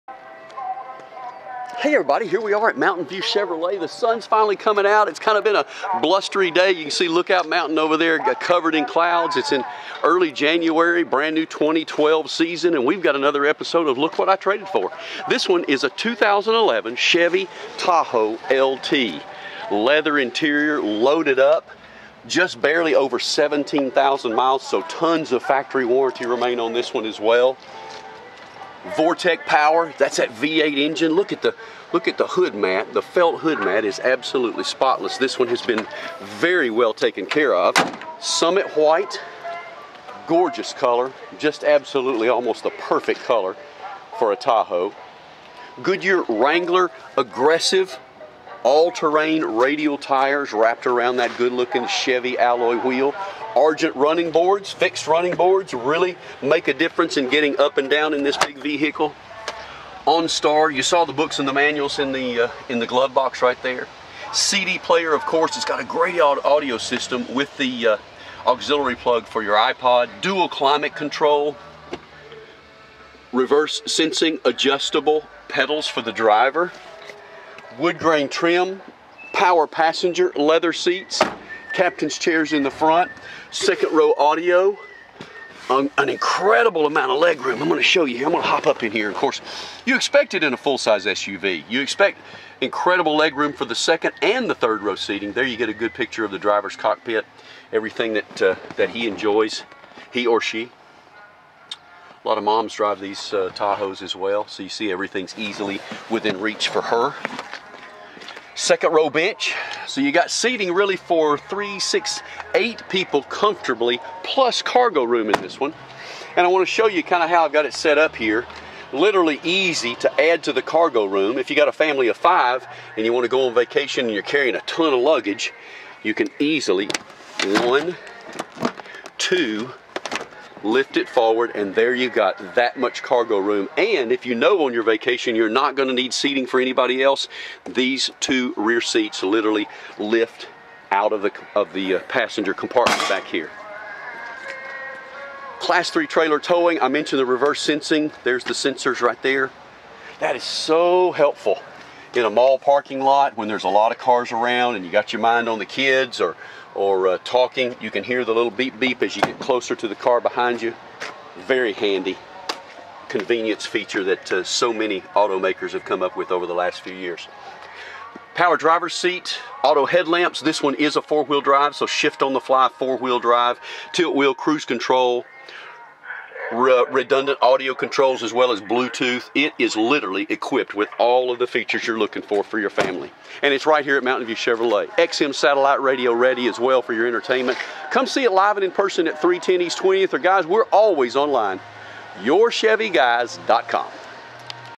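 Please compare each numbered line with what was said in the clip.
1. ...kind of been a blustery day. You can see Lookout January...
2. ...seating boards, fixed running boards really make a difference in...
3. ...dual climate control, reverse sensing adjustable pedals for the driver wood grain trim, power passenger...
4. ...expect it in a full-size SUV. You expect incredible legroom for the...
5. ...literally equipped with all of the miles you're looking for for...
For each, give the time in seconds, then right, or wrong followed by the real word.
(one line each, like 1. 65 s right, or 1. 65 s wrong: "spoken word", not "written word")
1. 5 s wrong: "Mountain", not "January"
2. 53 s wrong: "running", not "seating"
3. 70 s right
4. 89 s right
5. 179 s wrong: "features", not "miles".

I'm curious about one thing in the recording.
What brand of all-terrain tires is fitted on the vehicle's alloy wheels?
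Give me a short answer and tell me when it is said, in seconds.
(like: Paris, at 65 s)
Goodyear, at 45 s.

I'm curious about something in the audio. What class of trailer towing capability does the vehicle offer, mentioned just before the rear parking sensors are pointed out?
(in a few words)
Class 3.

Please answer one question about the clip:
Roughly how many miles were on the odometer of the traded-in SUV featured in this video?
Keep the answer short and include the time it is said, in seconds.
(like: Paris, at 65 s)
17,000, at 23 s.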